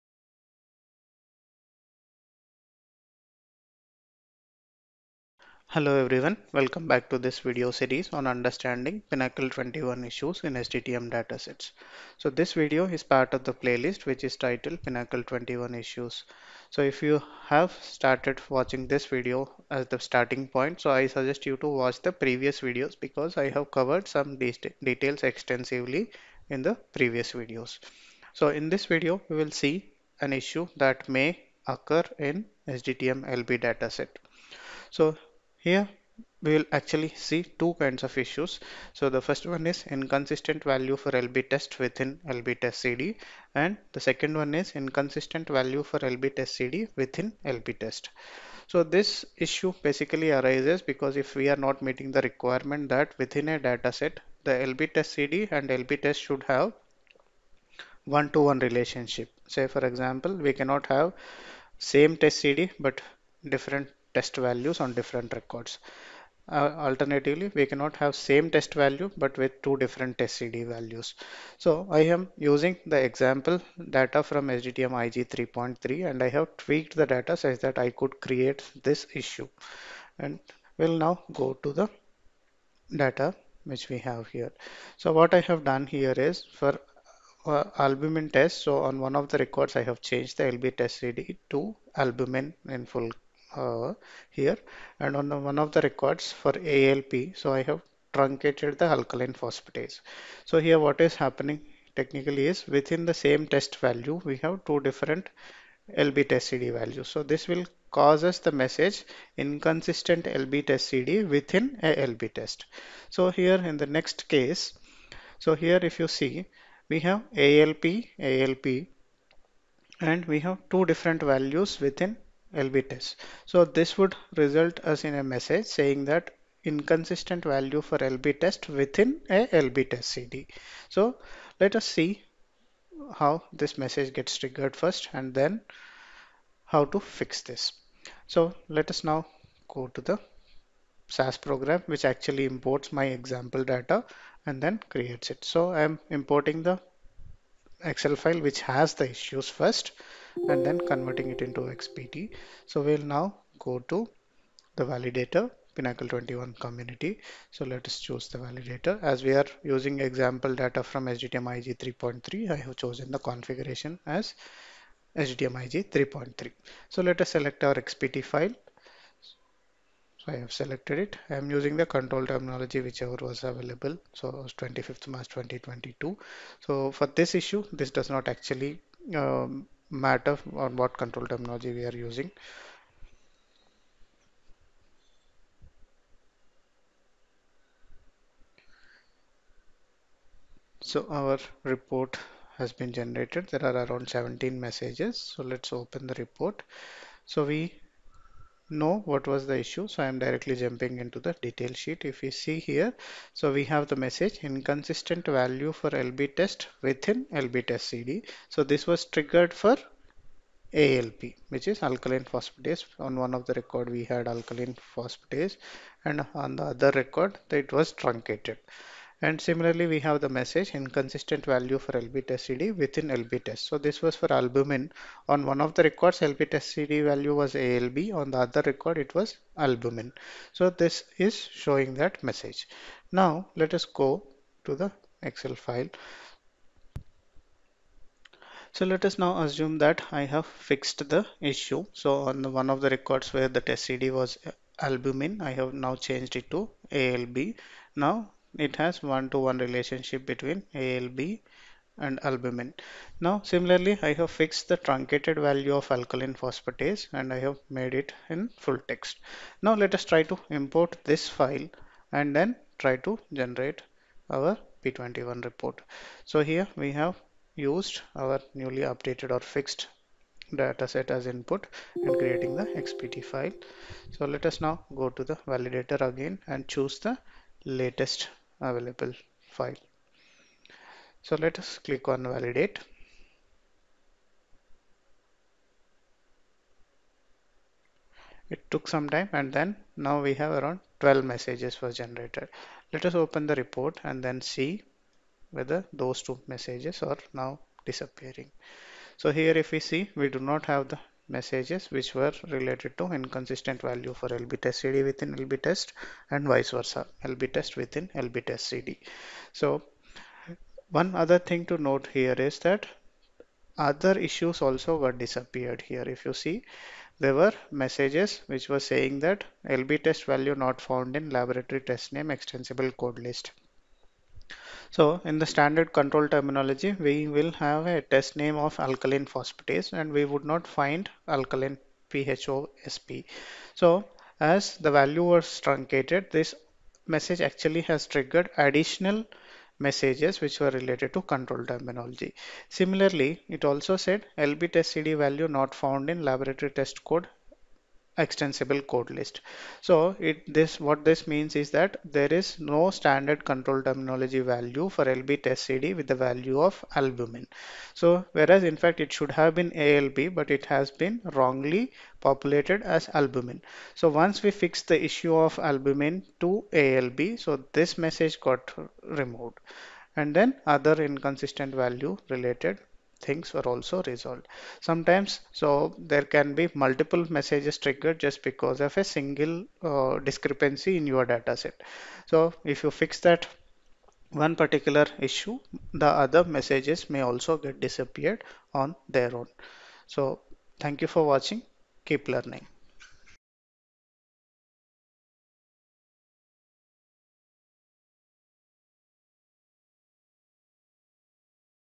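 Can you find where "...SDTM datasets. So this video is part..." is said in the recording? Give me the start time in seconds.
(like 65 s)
10 s.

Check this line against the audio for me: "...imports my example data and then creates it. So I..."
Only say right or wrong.
right.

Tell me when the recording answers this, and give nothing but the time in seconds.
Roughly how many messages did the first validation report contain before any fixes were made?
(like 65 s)
194 s.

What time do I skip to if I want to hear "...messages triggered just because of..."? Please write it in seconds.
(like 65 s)
377 s.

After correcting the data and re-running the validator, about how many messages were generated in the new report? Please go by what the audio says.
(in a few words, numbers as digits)
12.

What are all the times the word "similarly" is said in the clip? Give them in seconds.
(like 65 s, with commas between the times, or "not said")
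219 s, 253 s, 342 s.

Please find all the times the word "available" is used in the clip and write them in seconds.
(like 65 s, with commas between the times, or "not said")
173 s, 278 s.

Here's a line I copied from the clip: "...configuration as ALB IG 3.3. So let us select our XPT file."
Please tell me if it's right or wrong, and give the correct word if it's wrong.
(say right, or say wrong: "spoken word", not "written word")
wrong: "SDTM", not "ALB".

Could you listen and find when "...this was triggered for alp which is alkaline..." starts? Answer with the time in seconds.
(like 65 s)
208 s.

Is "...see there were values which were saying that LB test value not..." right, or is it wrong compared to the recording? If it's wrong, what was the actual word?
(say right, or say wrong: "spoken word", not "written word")
wrong: "messages", not "values".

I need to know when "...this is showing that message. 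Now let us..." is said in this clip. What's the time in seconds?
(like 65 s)
230 s.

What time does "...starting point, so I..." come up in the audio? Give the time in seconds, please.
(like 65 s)
19 s.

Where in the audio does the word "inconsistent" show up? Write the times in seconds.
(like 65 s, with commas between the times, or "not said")
39 s, 44 s, 109 s, 126 s, 204 s, 220 s, 303 s, 371 s.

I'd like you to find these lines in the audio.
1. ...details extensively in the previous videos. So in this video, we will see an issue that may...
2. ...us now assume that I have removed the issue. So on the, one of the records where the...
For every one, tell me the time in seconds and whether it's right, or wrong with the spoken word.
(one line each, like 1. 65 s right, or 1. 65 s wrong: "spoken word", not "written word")
1. 24 s right
2. 239 s wrong: "fixed", not "removed".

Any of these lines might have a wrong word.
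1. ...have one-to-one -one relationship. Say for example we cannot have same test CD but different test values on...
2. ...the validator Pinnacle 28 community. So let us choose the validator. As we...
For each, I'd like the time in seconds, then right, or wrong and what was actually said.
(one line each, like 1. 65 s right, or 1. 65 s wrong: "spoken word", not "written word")
1. 56 s right
2. 154 s wrong: "21", not "28".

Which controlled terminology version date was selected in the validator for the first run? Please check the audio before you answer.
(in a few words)
25th March 2022.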